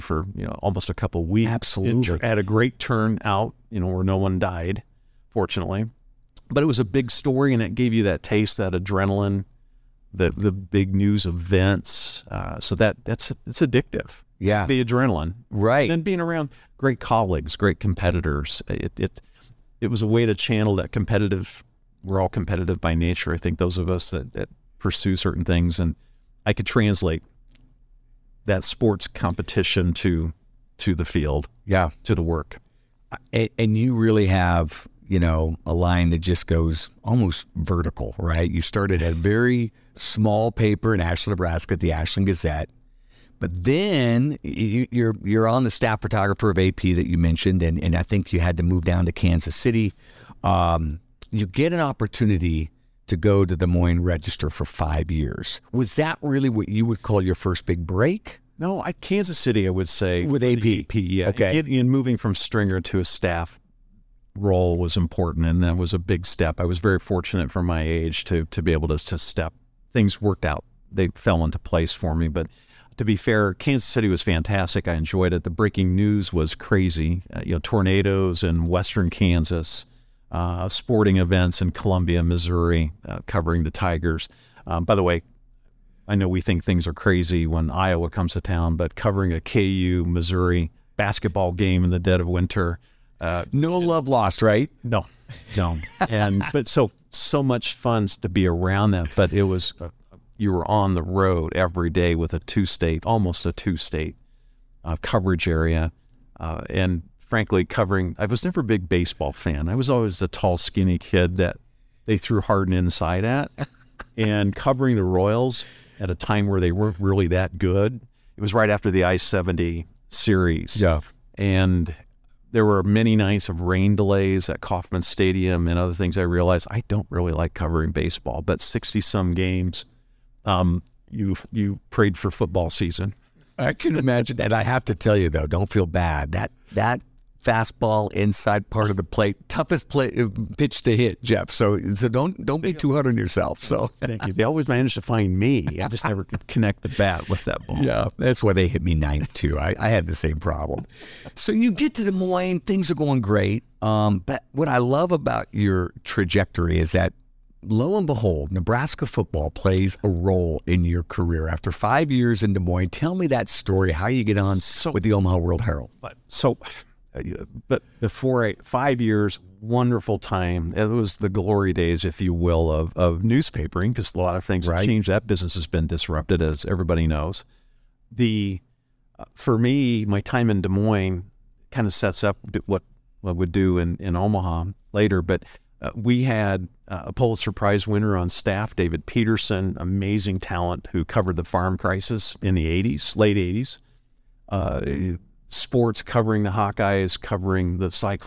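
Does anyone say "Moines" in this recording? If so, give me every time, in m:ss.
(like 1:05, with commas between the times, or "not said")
0:53, 2:32, 2:42, 3:00.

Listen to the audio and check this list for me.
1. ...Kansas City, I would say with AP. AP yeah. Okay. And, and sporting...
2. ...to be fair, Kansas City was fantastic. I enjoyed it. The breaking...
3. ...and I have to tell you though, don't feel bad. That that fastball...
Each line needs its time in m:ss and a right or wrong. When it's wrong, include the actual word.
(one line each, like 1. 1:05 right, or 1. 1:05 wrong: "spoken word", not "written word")
1. 0:58 wrong: "moving", not "sporting"
2. 1:12 right
3. 2:14 right.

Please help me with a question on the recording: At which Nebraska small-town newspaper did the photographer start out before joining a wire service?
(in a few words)
Ashland Gazette.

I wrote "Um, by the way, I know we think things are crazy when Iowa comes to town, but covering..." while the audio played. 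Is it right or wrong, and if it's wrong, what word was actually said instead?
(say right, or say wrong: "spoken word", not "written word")
right.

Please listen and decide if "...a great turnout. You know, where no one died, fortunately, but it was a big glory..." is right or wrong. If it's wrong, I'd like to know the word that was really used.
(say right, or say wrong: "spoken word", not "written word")
wrong: "story", not "glory".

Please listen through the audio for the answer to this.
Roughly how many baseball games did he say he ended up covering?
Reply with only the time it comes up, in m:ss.
2:08.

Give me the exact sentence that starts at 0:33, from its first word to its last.
Uh, and you really have, you know, a line that just goes almost vertical, right?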